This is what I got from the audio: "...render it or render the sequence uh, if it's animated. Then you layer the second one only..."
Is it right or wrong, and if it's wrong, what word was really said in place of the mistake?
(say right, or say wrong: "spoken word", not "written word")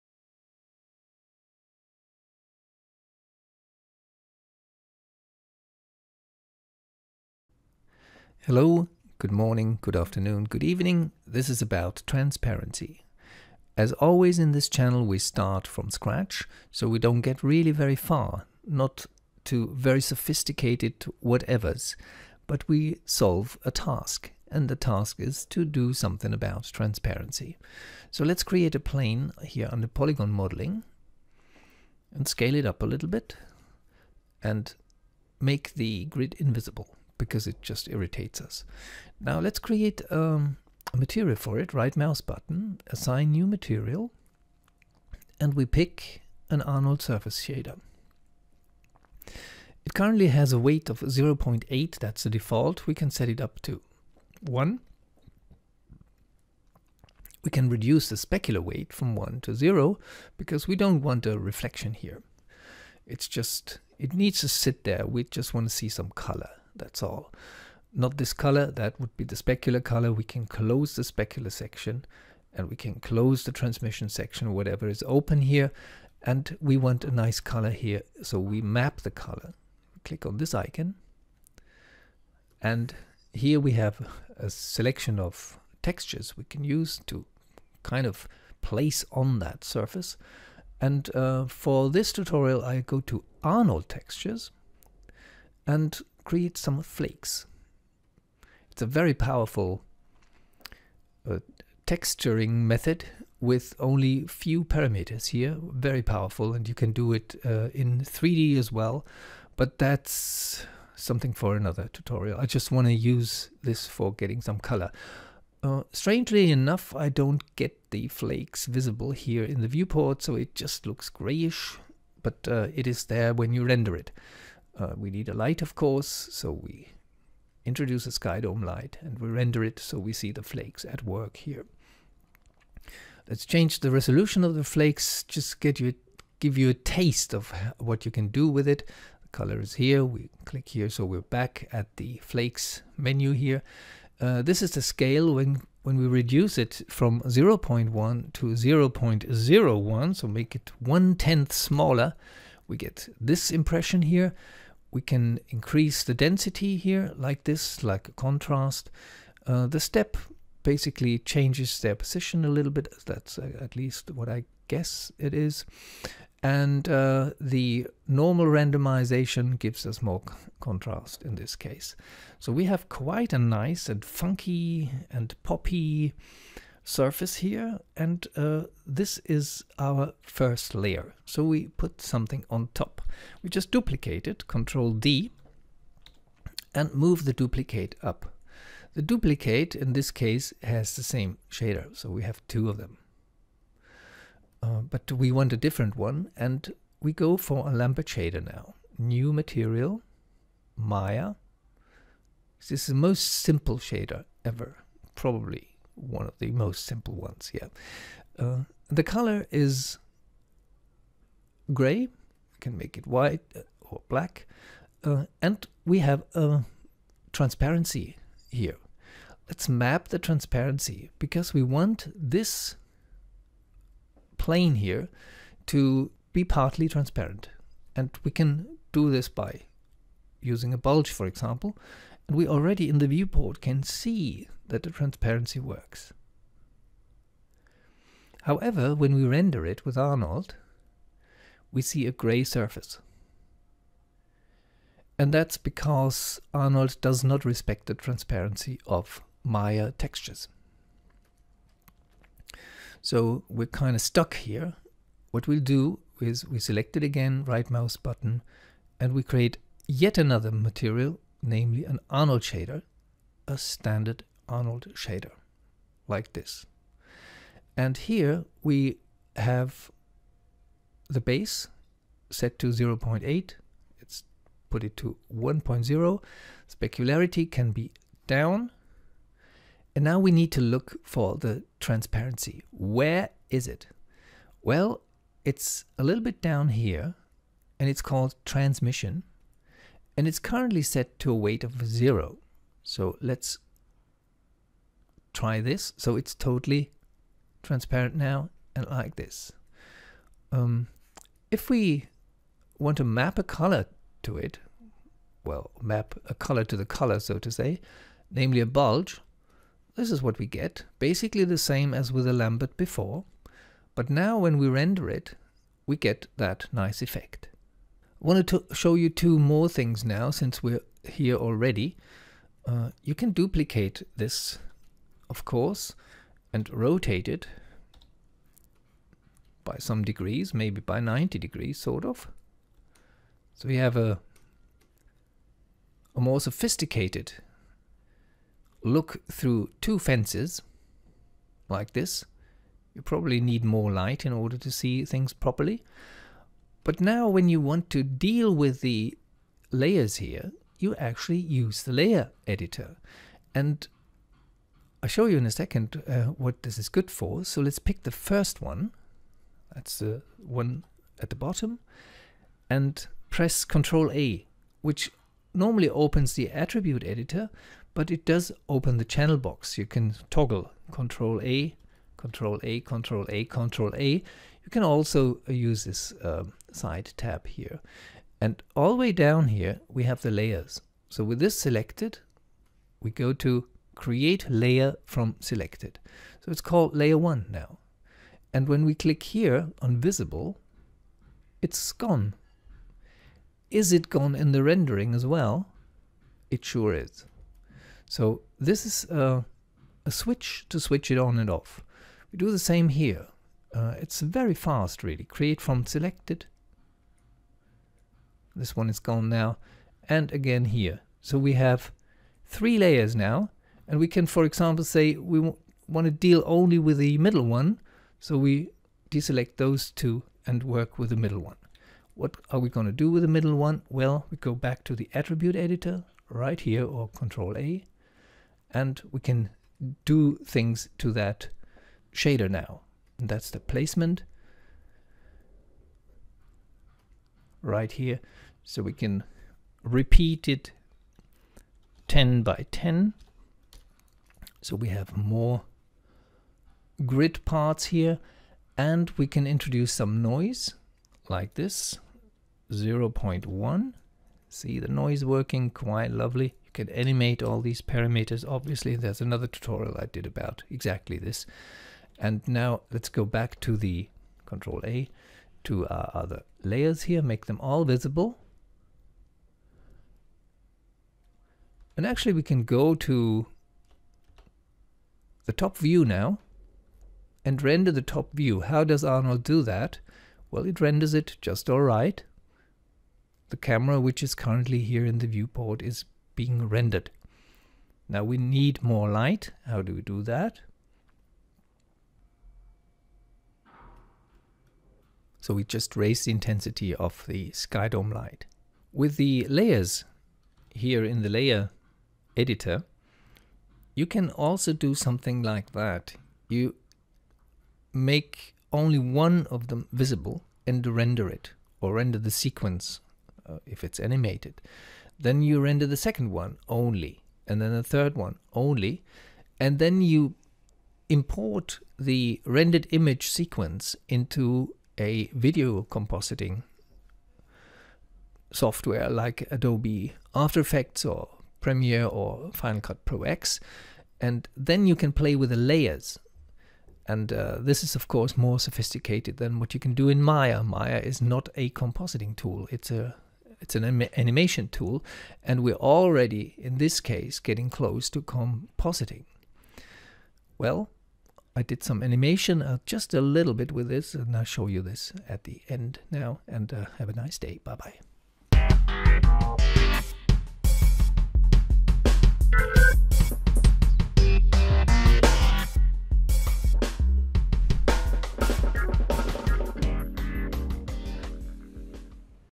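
wrong: "render", not "layer".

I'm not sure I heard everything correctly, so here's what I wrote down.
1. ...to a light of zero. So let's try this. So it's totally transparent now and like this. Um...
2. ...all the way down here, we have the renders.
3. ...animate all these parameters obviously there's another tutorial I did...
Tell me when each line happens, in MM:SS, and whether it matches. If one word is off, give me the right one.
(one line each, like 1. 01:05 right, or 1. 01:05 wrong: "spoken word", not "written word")
1. 04:51 wrong: "weight", not "light"
2. 06:18 wrong: "layers", not "renders"
3. 07:36 right.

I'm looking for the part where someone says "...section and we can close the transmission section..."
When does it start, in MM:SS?
01:11.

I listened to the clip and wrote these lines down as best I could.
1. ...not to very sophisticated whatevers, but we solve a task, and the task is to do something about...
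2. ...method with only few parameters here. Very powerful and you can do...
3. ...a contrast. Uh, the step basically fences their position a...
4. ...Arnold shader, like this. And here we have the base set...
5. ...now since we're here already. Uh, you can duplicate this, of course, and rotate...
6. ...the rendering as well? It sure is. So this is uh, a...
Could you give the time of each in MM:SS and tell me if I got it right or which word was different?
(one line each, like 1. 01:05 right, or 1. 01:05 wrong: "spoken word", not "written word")
1. 00:18 right
2. 01:42 right
3. 02:38 wrong: "changes", not "fences"
4. 04:24 right
5. 05:20 right
6. 06:34 right.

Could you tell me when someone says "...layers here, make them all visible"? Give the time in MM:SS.
07:46.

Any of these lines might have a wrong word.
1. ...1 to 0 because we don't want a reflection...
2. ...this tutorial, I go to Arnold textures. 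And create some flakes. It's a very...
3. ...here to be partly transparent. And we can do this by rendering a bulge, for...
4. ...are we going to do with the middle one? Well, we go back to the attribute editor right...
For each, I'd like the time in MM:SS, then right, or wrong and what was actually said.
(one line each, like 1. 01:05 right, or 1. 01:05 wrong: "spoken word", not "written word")
1. 00:59 right
2. 01:31 right
3. 03:44 wrong: "using", not "rendering"
4. 07:02 right.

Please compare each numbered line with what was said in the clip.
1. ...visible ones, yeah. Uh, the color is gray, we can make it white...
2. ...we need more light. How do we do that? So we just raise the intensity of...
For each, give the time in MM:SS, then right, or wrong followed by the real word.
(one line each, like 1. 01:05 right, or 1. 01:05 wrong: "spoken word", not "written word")
1. 03:26 wrong: "simple", not "visible"
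2. 08:08 right.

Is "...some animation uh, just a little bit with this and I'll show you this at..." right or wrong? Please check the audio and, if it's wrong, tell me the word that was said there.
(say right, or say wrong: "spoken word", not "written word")
right.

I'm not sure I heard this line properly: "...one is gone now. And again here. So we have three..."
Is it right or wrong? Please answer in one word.
right.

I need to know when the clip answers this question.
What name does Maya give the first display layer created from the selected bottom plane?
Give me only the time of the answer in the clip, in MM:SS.
06:26.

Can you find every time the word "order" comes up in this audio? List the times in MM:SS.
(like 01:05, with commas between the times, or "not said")
05:44.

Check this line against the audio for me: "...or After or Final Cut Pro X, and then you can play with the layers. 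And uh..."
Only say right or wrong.
wrong.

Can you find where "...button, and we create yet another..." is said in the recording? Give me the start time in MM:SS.
04:17.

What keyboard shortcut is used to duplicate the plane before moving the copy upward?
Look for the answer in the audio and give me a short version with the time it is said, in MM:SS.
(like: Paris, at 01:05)
Control D, at 03:04.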